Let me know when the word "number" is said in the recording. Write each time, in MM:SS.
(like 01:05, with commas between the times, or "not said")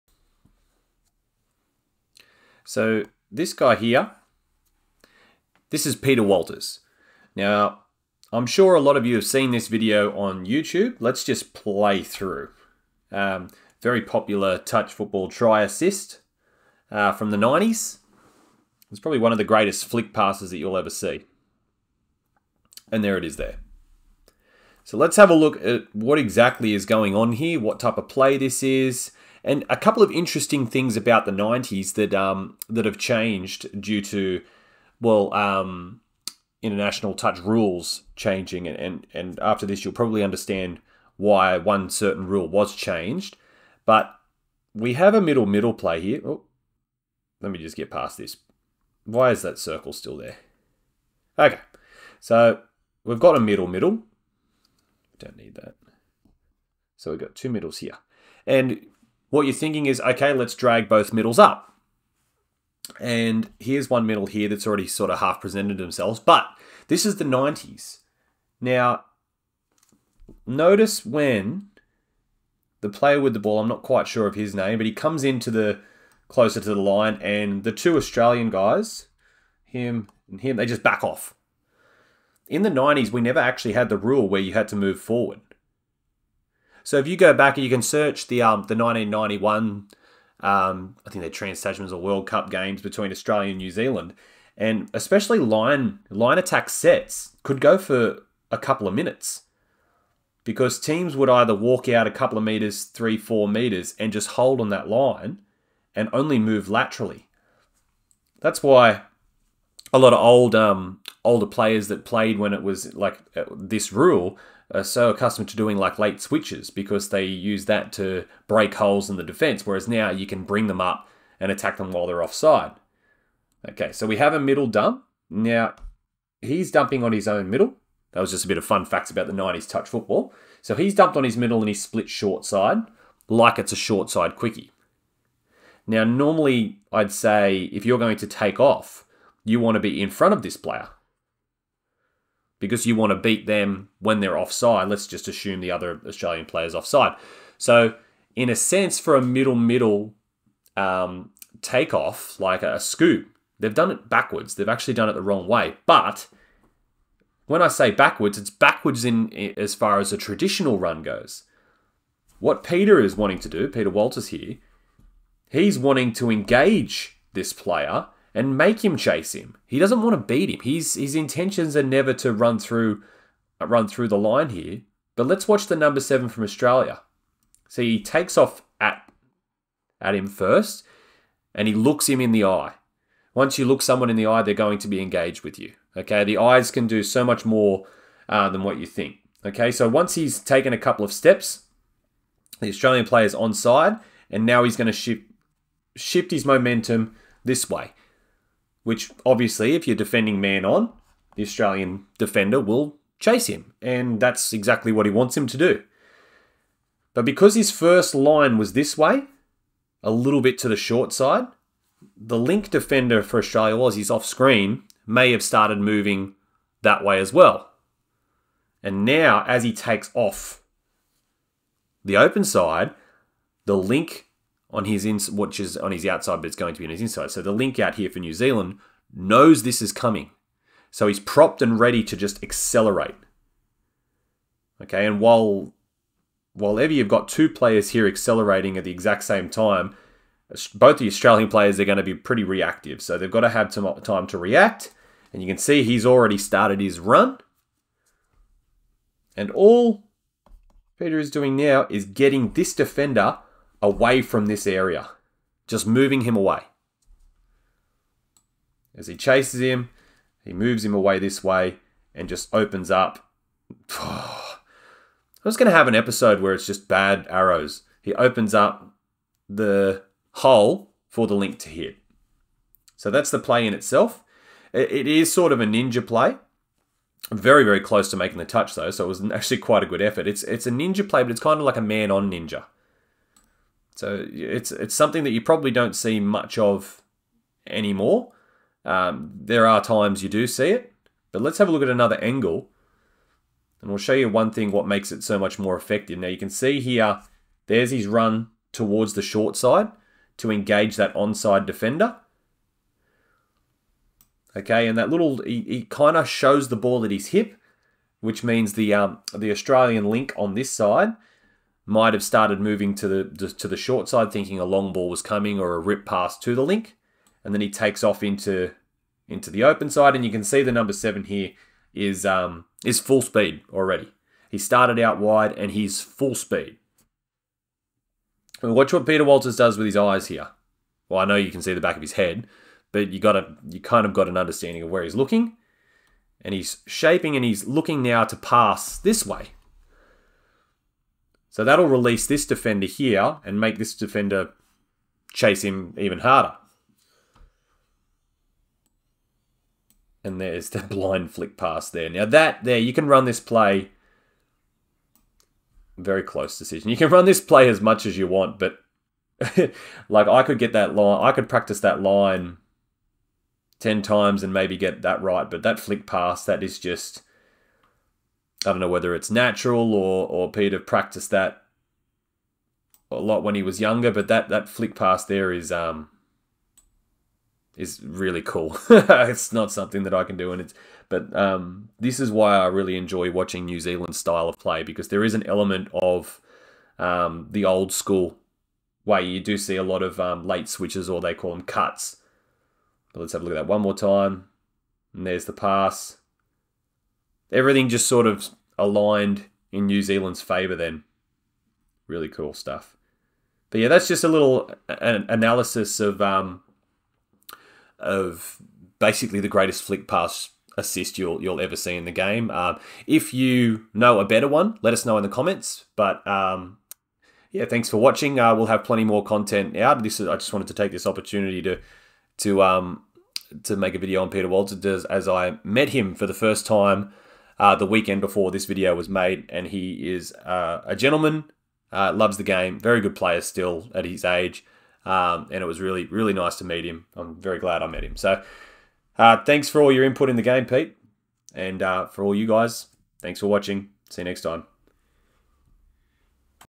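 02:55, 05:20.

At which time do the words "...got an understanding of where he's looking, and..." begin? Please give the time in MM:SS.
05:34.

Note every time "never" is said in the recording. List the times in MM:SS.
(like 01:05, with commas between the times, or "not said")
01:23, 02:51.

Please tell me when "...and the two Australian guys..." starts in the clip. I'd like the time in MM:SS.
01:17.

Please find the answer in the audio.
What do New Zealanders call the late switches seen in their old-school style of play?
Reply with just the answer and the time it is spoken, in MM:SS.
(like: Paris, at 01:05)
cuts, at 06:31.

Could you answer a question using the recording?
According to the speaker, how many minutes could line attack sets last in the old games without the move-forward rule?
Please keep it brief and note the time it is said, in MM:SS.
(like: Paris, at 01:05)
a couple of minutes, at 01:38.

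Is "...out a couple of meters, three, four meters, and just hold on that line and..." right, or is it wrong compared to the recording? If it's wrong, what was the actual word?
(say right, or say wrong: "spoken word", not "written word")
right.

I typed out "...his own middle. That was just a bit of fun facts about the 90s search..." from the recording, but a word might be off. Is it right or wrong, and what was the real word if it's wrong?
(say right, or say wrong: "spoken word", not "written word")
wrong: "touch", not "search".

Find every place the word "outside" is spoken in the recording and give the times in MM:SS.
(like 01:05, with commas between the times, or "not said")
03:46.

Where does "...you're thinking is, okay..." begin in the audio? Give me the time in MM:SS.
00:59.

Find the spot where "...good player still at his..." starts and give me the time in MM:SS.
07:13.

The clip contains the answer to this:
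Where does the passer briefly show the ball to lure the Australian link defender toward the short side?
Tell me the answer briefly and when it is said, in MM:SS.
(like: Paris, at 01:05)
at his hip, at 05:07.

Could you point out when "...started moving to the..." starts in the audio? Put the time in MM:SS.
05:12.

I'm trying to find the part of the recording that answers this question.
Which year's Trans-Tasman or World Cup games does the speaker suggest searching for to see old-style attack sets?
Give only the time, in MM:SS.
01:28.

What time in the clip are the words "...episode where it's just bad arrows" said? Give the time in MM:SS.
04:25.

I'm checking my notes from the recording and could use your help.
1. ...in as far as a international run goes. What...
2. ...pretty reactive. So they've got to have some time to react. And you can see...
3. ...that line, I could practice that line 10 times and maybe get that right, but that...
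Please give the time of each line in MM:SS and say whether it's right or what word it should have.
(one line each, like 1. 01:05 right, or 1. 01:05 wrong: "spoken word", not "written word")
1. 02:39 wrong: "traditional", not "international"
2. 04:02 right
3. 06:00 right.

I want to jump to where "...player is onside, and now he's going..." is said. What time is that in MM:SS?
03:13.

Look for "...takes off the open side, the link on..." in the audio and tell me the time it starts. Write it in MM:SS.
03:39.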